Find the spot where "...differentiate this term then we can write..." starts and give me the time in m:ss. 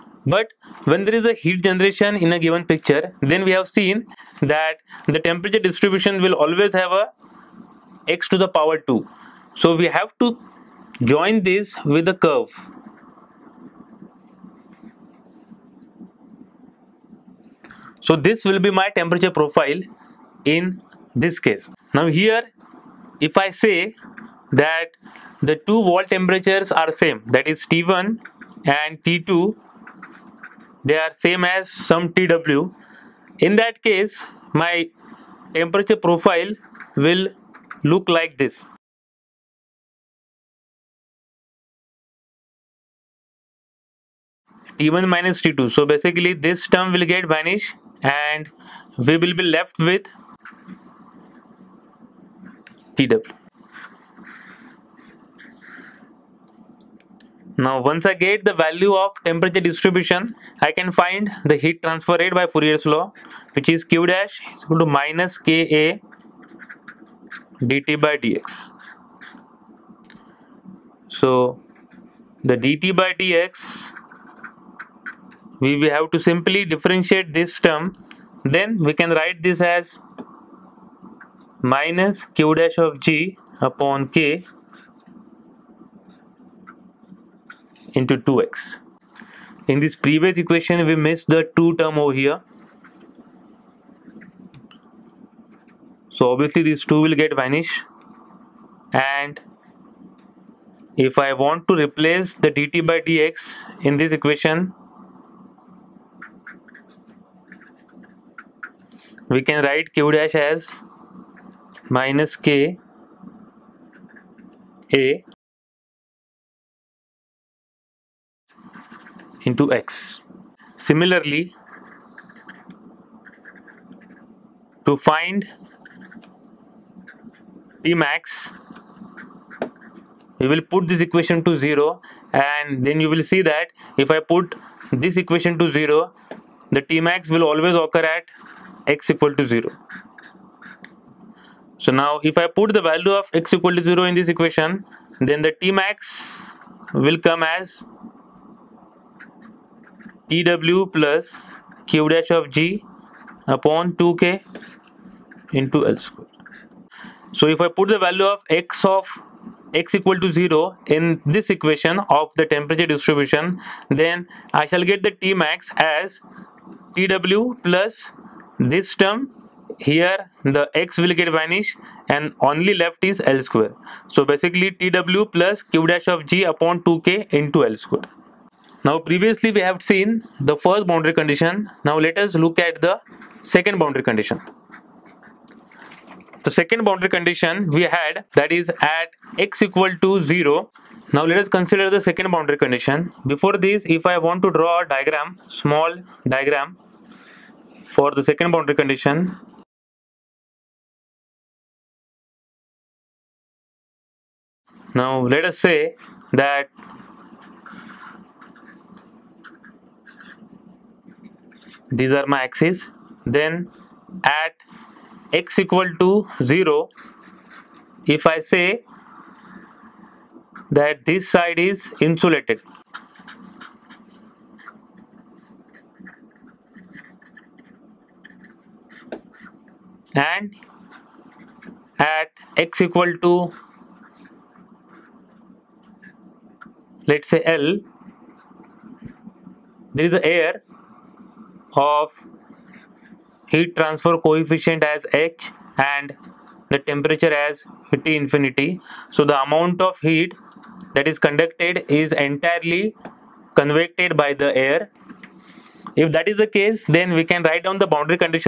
1:16.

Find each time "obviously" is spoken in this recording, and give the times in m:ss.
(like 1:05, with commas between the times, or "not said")
1:36.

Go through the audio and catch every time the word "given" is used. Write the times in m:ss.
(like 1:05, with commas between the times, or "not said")
0:02.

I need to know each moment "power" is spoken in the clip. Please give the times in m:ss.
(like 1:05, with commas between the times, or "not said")
0:08.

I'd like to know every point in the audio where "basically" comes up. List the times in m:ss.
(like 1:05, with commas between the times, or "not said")
0:45, 2:54.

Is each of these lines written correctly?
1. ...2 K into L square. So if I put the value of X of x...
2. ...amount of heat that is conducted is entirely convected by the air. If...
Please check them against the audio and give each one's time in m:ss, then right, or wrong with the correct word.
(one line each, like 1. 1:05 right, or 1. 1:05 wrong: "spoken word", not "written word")
1. 2:33 right
2. 4:09 right.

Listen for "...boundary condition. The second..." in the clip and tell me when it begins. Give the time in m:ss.
3:03.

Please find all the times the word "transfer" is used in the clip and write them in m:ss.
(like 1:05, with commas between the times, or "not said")
1:01, 4:03.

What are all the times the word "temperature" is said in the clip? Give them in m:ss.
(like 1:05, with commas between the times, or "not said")
0:05, 0:18, 0:26, 0:35, 0:59, 2:42, 4:06.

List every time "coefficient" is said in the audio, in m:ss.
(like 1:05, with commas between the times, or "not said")
4:04.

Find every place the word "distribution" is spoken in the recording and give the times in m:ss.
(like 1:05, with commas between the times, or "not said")
0:05, 0:59, 2:42.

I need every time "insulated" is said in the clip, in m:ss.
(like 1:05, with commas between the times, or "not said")
3:41.